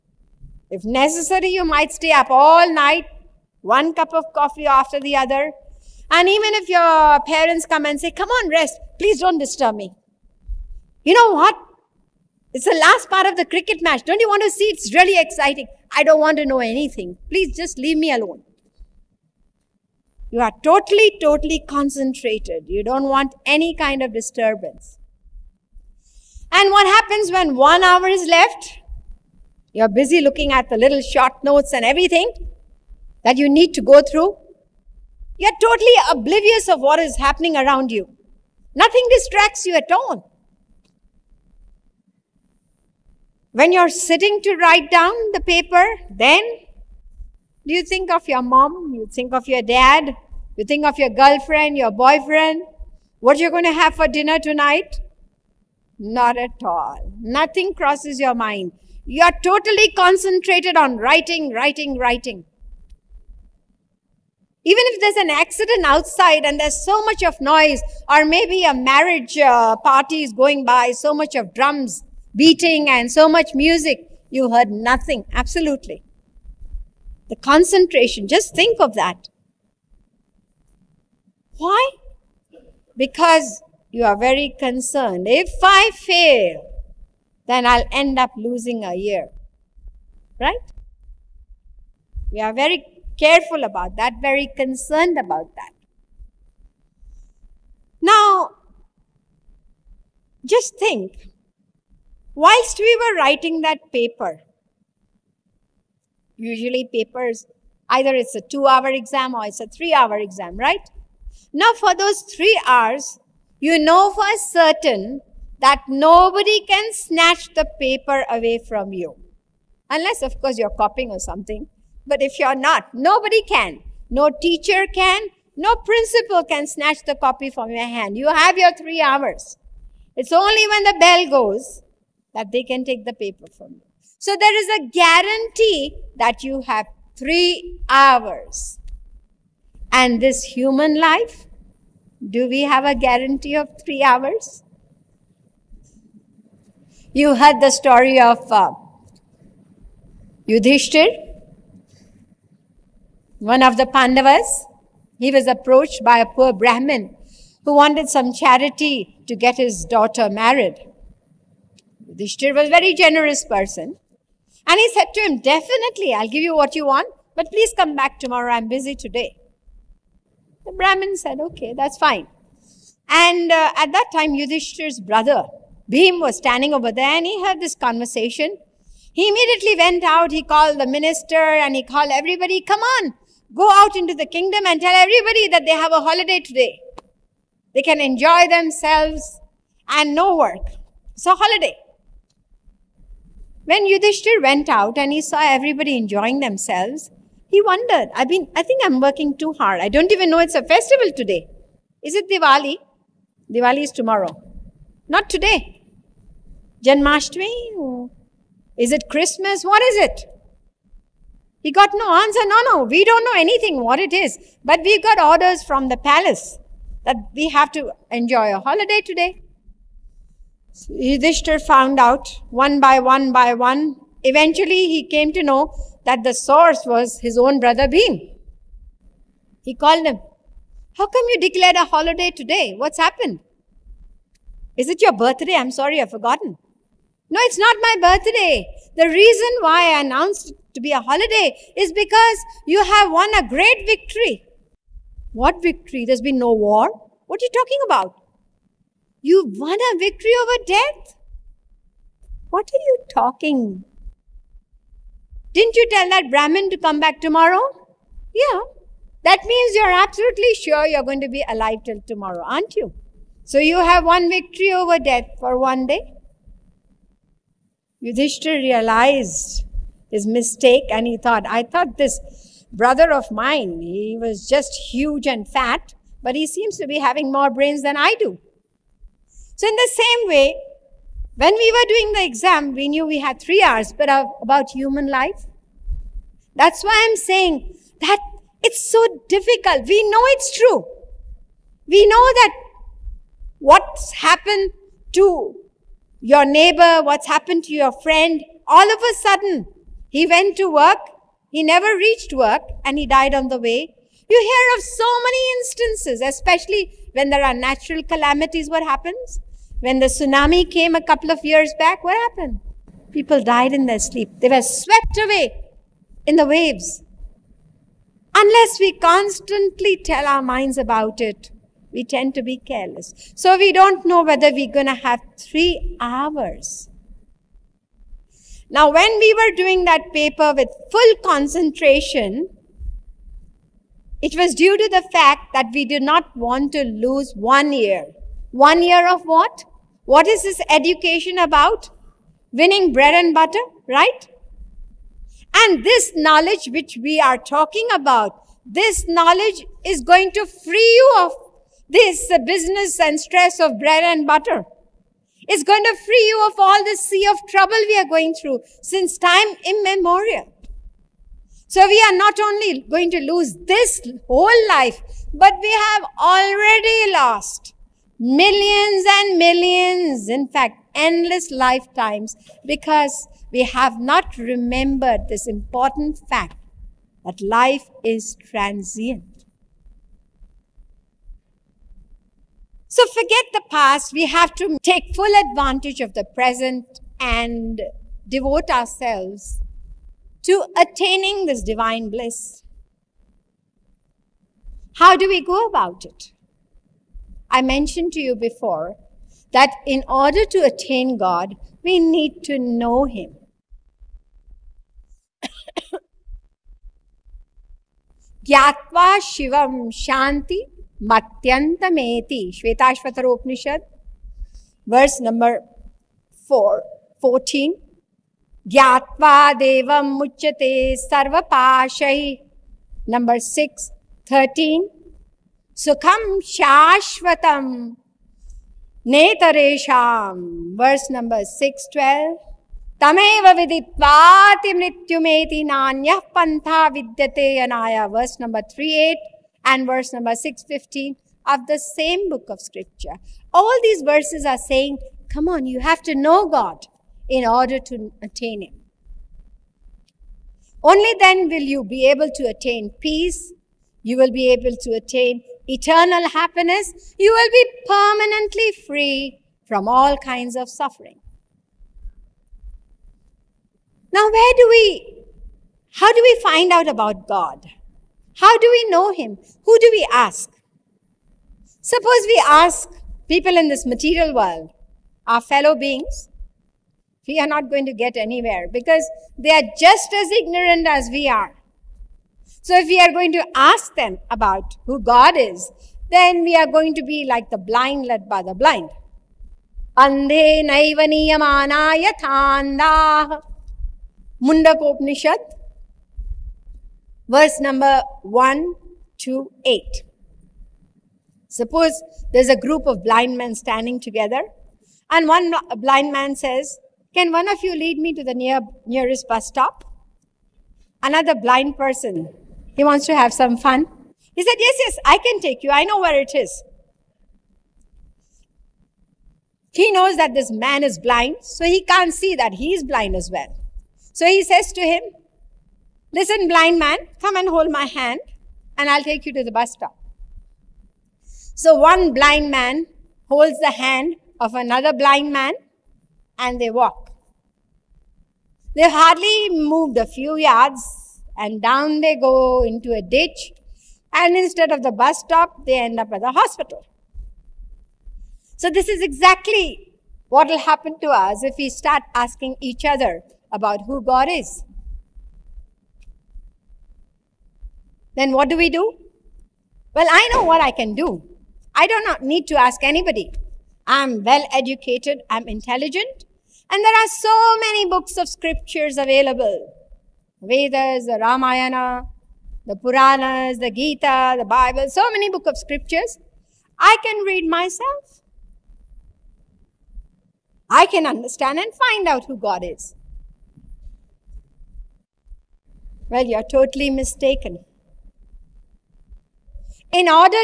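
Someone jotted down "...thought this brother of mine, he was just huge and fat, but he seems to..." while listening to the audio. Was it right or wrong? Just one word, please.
right.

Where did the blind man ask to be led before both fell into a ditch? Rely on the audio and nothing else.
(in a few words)
Nearest bus stop.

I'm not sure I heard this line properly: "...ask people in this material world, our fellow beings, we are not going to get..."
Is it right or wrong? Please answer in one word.
right.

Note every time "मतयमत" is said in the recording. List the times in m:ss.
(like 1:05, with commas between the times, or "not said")
7:14.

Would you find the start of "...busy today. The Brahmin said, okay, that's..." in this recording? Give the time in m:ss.
2:48.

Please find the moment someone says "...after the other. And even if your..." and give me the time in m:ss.
0:04.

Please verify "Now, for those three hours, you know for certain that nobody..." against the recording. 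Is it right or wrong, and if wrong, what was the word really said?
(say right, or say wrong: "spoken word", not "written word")
right.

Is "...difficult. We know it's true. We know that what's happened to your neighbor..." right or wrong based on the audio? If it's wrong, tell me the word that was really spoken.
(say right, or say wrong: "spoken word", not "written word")
right.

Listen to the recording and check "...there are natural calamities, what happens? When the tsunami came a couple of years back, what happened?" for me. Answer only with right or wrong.
right.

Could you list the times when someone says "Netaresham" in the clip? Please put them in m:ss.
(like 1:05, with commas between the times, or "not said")
7:09.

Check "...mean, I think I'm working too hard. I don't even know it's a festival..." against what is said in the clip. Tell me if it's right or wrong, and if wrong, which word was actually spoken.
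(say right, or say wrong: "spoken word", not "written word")
right.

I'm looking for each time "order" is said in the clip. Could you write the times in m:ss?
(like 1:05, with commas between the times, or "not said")
3:35, 6:40, 7:27.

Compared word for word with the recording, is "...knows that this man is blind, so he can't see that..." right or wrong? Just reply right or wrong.
right.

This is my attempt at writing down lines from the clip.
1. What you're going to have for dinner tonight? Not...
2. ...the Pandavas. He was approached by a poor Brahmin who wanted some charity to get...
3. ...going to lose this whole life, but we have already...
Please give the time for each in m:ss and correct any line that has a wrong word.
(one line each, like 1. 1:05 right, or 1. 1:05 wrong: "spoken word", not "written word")
1. 0:53 right
2. 2:33 right
3. 6:02 right.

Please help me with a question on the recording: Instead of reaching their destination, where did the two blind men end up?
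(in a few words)
Hospital.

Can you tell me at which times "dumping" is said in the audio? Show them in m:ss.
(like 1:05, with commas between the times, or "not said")
not said.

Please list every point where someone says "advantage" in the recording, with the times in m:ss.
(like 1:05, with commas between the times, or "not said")
6:25.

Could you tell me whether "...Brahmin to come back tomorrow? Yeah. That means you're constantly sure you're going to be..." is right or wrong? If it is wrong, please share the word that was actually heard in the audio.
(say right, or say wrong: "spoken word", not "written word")
wrong: "absolutely", not "constantly".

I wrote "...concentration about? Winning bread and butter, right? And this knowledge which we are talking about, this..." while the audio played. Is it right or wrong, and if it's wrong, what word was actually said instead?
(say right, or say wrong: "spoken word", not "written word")
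wrong: "education", not "concentration".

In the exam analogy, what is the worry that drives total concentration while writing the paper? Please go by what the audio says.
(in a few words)
Losing a year.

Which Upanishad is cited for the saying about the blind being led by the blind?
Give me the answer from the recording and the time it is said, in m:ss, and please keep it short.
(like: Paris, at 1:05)
Mundak Upanishad, at 8:14.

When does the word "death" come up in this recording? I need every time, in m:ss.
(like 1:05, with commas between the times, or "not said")
4:10, 4:24.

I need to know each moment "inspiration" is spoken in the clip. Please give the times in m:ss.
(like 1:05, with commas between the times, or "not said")
not said.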